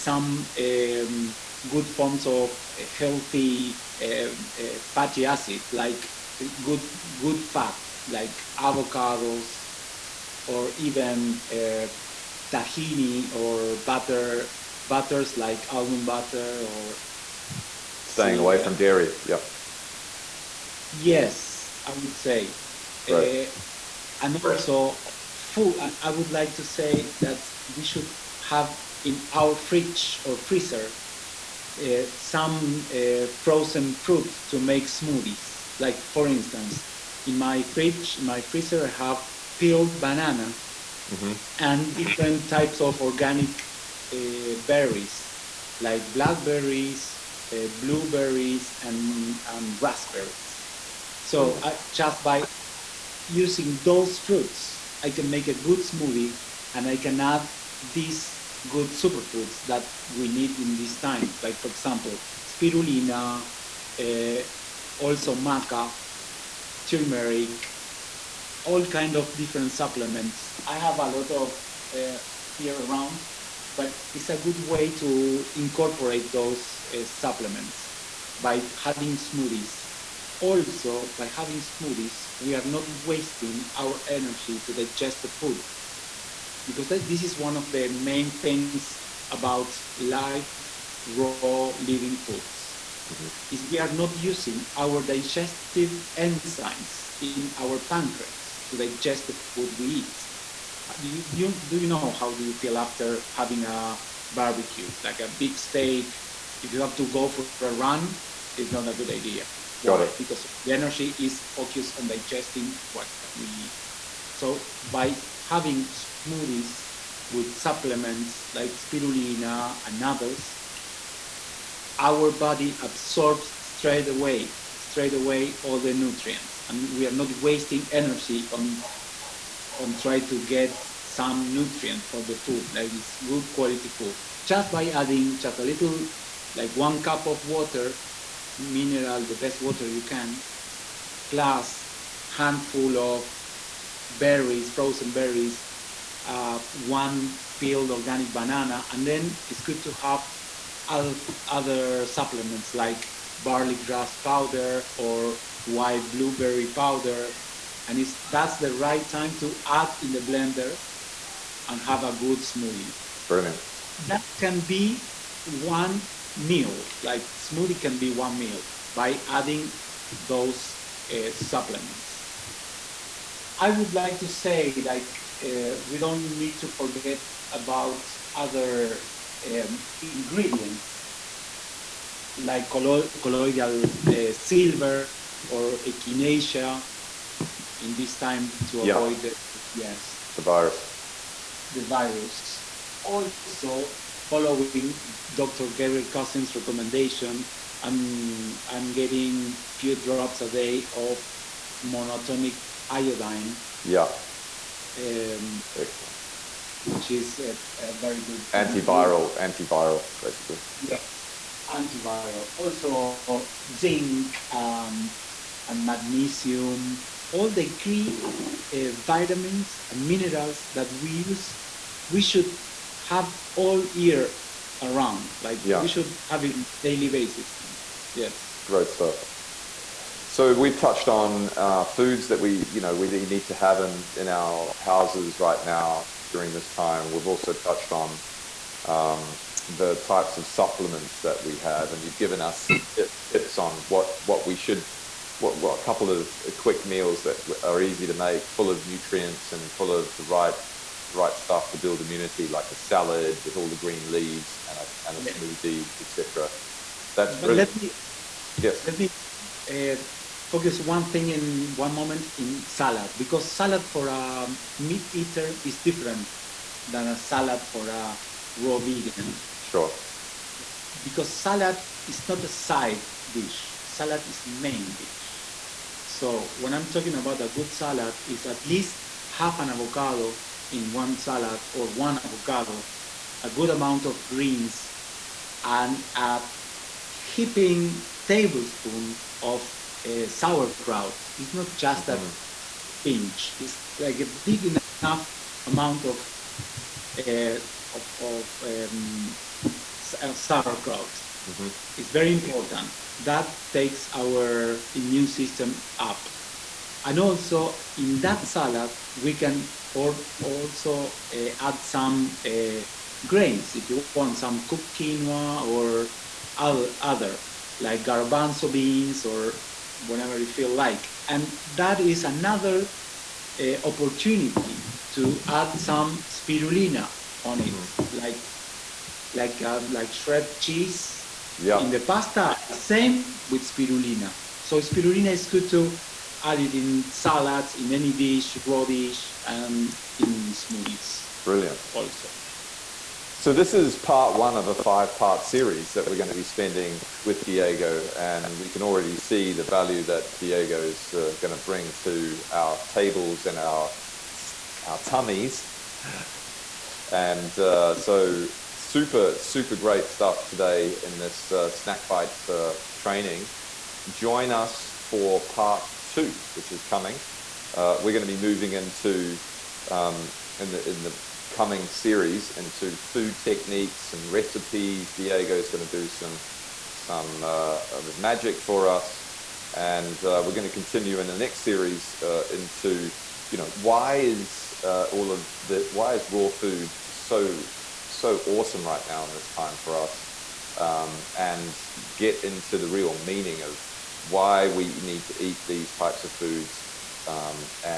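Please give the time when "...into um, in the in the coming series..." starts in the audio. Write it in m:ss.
6:08.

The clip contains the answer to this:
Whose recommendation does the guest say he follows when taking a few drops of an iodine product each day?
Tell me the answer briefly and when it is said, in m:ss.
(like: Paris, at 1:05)
Dr Gabriel Cousens, at 3:15.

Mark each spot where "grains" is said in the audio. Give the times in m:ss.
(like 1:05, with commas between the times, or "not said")
5:13.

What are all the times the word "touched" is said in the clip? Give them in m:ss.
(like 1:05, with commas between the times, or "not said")
3:50, 3:57.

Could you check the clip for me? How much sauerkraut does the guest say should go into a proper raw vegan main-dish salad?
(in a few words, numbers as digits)
A heaping tablespoon.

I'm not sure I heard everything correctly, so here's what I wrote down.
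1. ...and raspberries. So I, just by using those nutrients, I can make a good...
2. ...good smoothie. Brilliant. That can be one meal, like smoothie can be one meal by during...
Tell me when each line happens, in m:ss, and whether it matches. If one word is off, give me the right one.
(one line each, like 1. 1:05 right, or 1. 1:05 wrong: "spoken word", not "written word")
1. 0:49 wrong: "fruits", not "nutrients"
2. 2:42 wrong: "adding", not "during".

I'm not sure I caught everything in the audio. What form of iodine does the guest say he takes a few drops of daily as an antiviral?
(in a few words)
Monatomic iodine.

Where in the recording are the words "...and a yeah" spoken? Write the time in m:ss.
4:15.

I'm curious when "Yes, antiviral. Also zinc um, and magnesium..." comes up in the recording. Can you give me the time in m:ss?
3:30.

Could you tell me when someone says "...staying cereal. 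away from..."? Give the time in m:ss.
0:18.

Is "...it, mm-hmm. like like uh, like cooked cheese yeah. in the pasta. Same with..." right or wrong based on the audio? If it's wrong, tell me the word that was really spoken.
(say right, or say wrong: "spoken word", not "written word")
wrong: "shred", not "cooked".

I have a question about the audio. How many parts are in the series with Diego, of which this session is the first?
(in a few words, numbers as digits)
5.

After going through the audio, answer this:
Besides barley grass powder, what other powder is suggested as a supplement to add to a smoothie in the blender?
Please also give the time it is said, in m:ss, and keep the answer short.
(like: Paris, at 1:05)
White blueberry powder, at 2:35.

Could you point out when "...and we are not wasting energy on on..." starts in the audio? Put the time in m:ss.
2:06.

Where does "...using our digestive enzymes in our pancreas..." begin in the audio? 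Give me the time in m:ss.
1:34.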